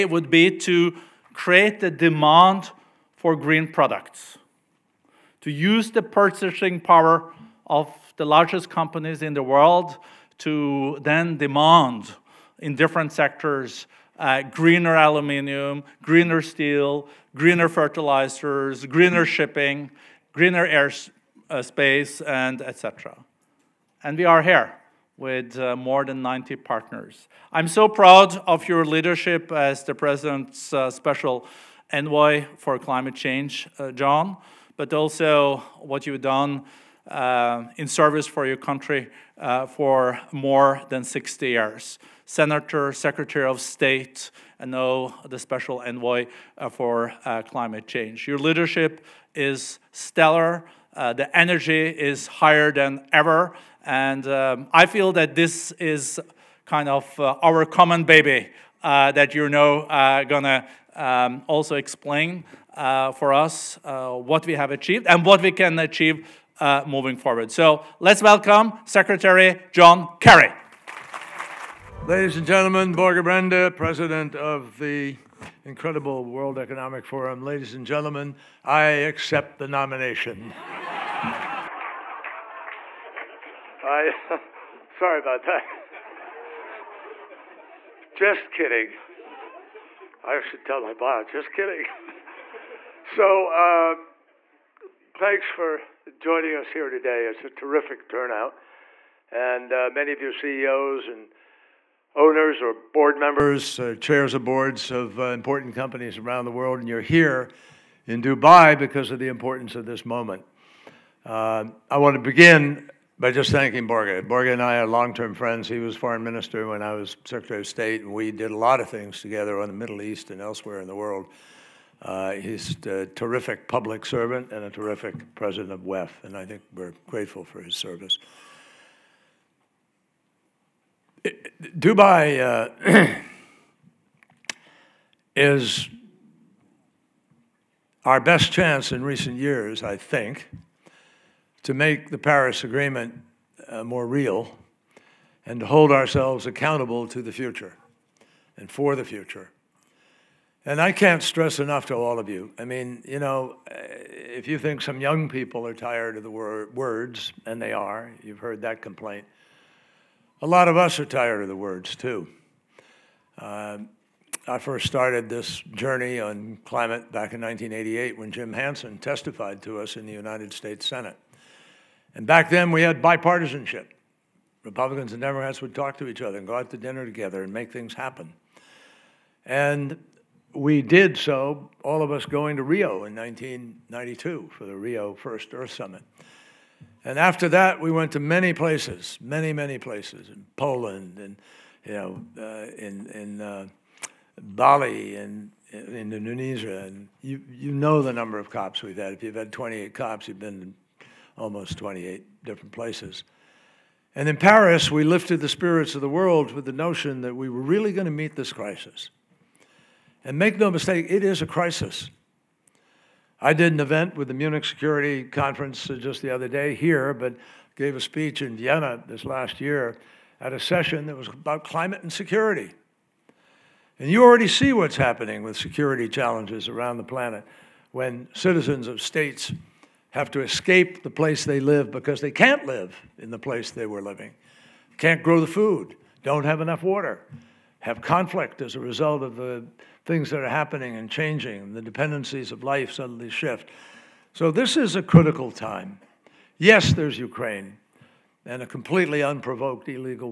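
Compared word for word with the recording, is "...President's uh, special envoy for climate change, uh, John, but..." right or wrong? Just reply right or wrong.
right.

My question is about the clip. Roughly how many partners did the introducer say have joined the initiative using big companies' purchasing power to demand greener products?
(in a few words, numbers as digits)
more than 90.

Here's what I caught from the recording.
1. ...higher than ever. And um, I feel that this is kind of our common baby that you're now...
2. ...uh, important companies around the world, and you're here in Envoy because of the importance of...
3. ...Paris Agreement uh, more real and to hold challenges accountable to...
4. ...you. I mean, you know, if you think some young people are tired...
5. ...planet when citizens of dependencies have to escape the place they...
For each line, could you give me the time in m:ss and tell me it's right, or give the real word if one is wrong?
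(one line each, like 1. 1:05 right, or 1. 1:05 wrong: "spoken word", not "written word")
1. 0:52 right
2. 1:45 wrong: "Dubai", not "Envoy"
3. 2:22 wrong: "ourselves", not "challenges"
4. 2:32 right
5. 3:47 wrong: "states", not "dependencies".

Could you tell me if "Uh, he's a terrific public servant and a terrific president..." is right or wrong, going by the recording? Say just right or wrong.
right.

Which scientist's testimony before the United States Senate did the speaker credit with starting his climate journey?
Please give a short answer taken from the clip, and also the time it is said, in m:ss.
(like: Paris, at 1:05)
Jim Hansen, at 2:48.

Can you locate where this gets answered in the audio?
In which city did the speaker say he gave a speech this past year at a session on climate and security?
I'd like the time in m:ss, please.
3:38.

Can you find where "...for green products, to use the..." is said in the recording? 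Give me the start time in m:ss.
0:03.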